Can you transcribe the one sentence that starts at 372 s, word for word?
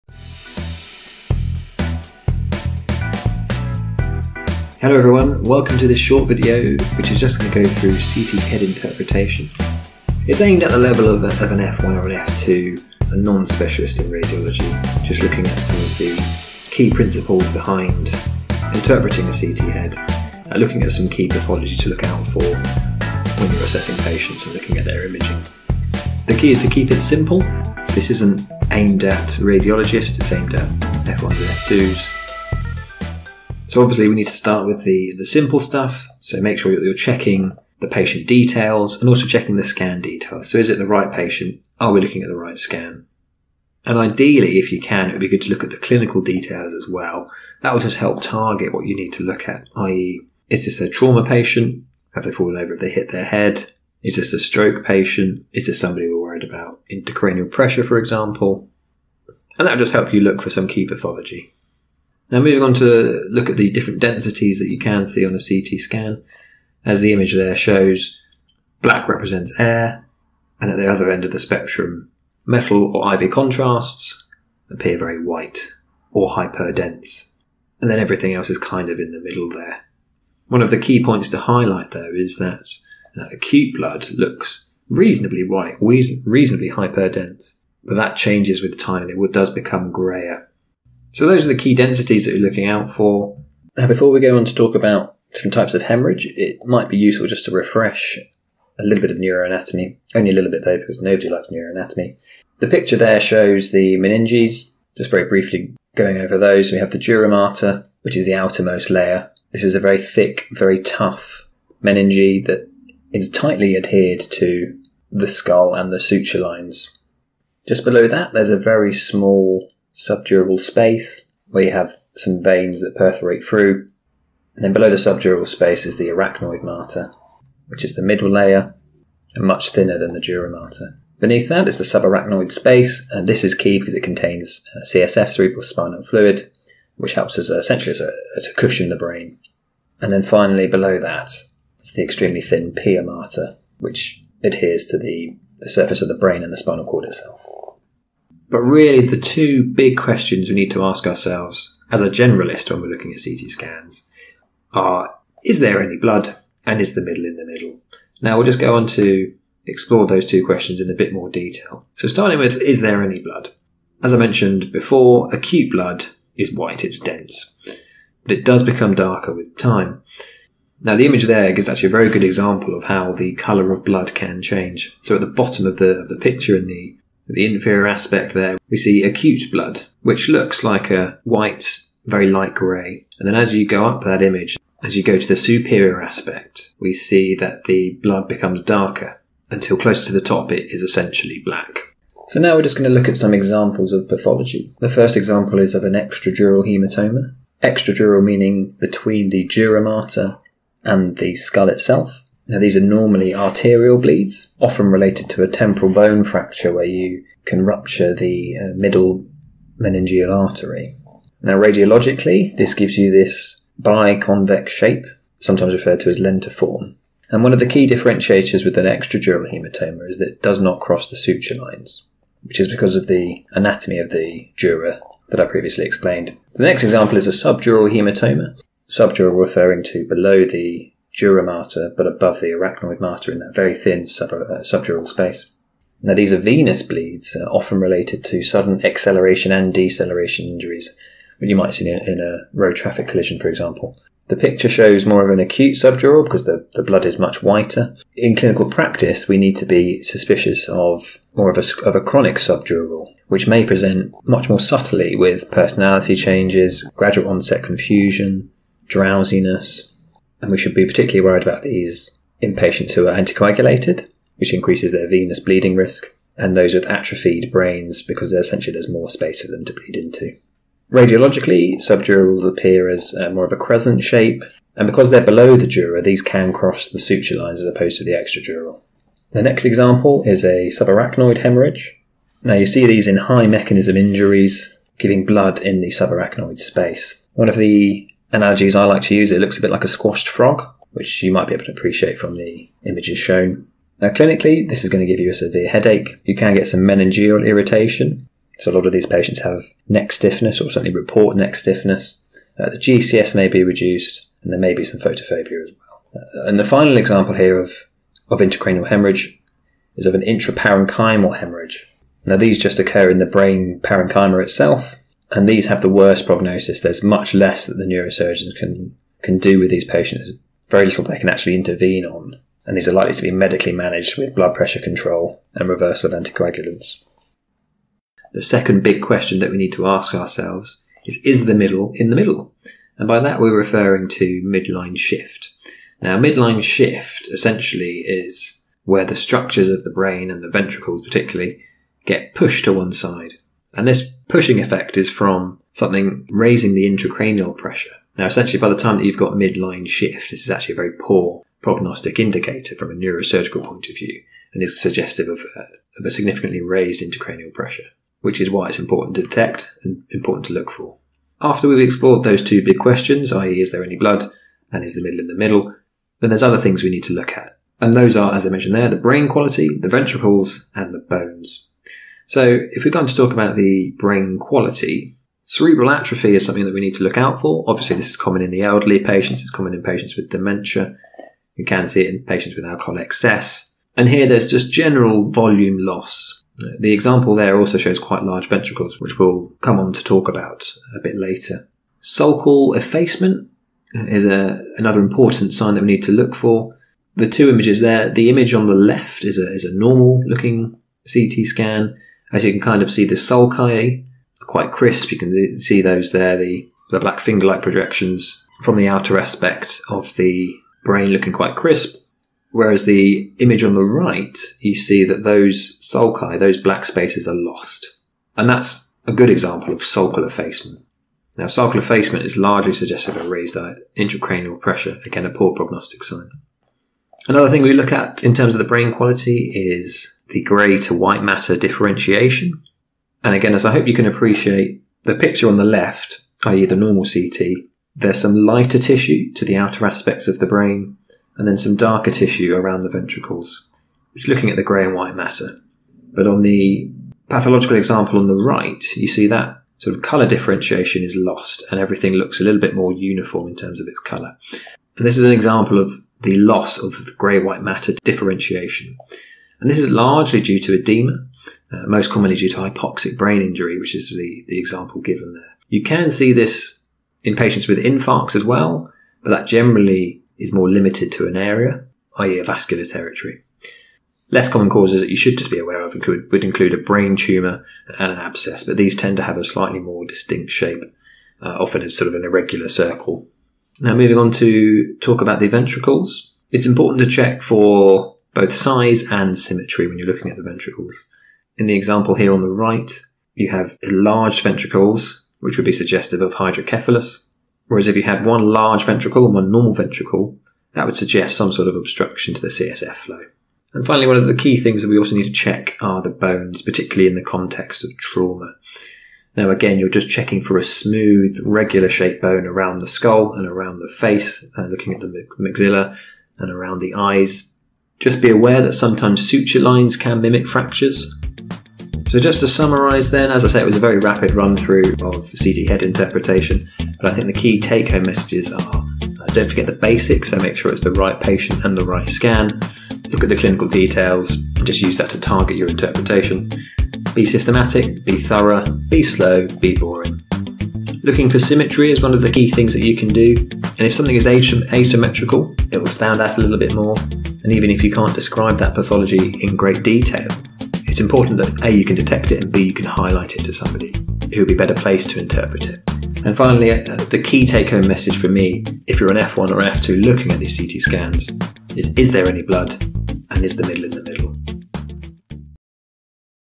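So, if we're going to talk about the brain quality, cerebral atrophy is something that we need to look out for.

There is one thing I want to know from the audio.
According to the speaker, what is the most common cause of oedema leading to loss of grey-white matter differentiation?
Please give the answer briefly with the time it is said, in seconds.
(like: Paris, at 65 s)
Hypoxic brain injury, at 462 s.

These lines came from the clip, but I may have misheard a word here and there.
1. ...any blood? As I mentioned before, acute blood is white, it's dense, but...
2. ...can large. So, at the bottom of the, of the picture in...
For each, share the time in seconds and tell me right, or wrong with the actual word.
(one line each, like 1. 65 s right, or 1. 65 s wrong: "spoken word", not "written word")
1. 163 s right
2. 174 s wrong: "change", not "large".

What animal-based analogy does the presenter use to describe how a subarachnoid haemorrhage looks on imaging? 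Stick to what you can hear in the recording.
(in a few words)
A squashed frog.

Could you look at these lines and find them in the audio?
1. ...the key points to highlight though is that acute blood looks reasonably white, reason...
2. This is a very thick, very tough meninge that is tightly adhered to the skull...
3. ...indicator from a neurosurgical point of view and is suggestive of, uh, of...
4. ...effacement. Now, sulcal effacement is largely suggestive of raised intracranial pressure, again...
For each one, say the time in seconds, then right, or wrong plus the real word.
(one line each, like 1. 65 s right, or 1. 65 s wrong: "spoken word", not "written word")
1. 80 s right
2. 109 s right
3. 352 s right
4. 420 s right.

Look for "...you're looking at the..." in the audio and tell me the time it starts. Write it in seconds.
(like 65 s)
489 s.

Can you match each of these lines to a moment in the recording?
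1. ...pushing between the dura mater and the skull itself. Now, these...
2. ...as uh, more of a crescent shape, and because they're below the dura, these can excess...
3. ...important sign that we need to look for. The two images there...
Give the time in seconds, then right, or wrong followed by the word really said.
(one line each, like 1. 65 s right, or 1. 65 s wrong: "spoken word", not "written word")
1. 198 s wrong: "meaning", not "pushing"
2. 272 s wrong: "cross", not "excess"
3. 395 s right.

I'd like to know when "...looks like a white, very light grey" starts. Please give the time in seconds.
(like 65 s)
180 s.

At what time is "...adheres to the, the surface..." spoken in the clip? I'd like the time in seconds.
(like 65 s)
144 s.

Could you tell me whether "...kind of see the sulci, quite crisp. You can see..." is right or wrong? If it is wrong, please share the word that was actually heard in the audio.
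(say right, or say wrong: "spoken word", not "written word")
right.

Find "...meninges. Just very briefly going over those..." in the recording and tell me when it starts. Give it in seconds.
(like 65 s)
103 s.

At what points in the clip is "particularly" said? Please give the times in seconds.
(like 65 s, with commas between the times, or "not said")
260 s, 341 s, 506 s.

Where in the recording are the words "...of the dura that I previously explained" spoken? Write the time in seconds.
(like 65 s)
223 s.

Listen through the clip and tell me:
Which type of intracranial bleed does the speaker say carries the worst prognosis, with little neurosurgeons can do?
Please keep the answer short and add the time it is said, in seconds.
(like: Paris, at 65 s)
Intraparenchymal hemorrhage, at 310 s.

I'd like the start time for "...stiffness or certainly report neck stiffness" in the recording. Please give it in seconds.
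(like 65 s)
300 s.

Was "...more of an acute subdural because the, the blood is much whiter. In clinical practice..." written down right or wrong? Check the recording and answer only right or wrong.
right.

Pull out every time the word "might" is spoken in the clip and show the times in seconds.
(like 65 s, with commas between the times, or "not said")
96 s, 241 s, 291 s.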